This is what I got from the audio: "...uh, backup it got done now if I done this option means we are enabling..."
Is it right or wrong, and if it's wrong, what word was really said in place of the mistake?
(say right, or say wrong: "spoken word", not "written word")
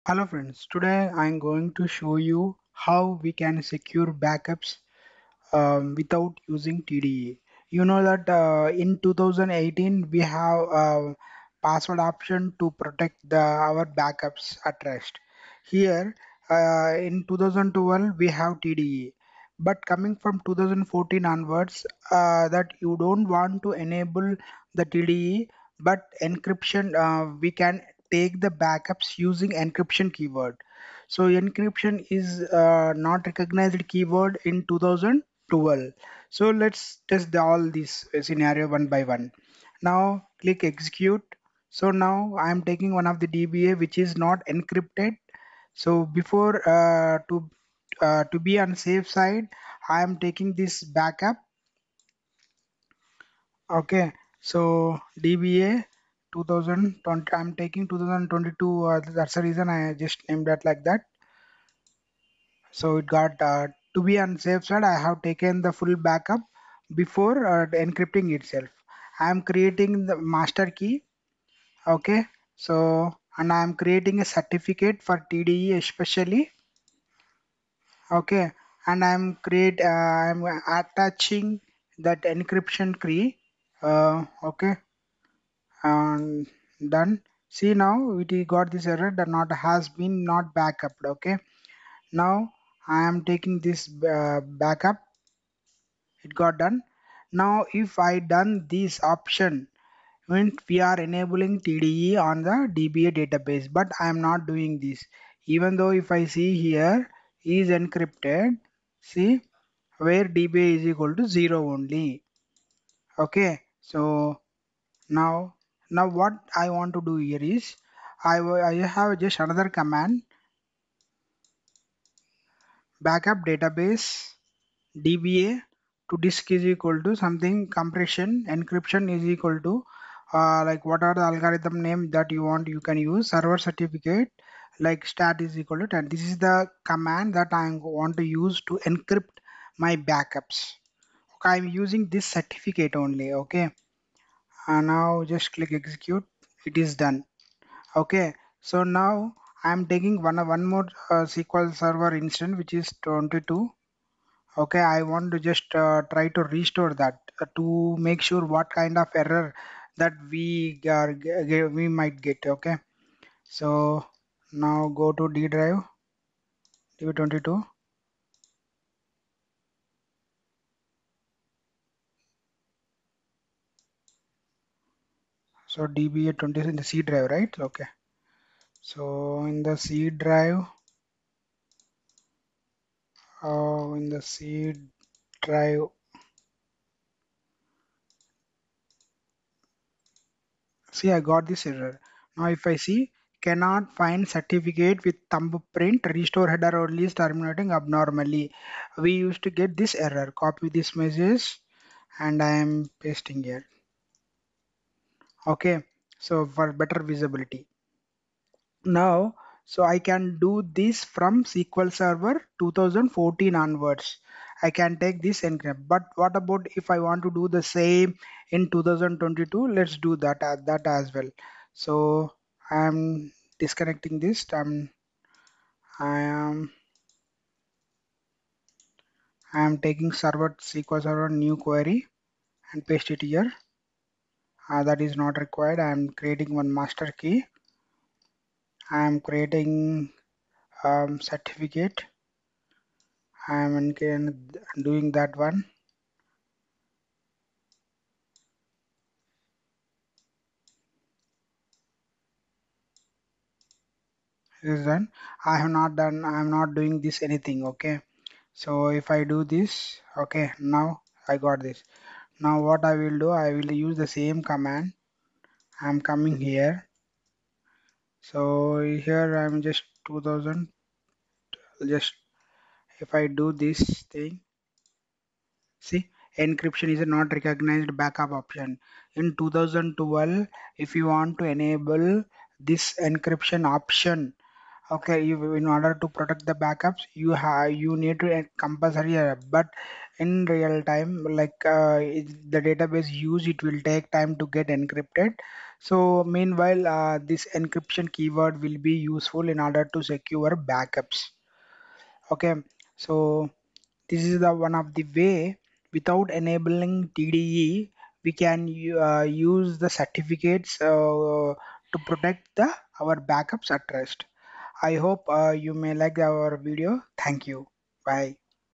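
right.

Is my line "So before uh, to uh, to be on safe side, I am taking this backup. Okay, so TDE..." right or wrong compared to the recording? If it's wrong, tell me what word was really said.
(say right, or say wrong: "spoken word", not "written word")
wrong: "DBA", not "TDE".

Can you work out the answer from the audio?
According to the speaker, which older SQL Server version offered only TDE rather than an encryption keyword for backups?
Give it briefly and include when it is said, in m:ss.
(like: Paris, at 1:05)
2012, at 0:16.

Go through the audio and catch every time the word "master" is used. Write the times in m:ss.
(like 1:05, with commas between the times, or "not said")
1:10, 3:56.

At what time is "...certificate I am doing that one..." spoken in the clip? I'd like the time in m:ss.
4:01.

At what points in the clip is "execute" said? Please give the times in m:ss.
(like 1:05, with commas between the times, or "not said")
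0:40, 2:25.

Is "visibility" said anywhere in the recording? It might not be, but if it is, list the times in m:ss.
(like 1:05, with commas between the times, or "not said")
3:27.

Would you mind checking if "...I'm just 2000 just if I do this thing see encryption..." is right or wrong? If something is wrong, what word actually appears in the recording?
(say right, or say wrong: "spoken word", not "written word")
right.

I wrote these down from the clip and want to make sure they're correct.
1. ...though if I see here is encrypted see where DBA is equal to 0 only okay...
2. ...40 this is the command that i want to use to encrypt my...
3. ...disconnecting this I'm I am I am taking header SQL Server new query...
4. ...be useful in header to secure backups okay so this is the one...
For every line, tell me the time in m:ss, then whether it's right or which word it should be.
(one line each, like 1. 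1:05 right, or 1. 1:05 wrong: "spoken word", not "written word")
1. 1:45 right
2. 2:15 wrong: "10", not "40"
3. 3:43 wrong: "server", not "header"
4. 4:58 wrong: "order", not "header".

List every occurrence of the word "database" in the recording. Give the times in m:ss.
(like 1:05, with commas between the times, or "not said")
1:43, 2:03, 4:52.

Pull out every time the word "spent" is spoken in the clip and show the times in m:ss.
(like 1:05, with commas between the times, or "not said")
not said.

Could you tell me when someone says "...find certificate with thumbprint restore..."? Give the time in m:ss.
3:13.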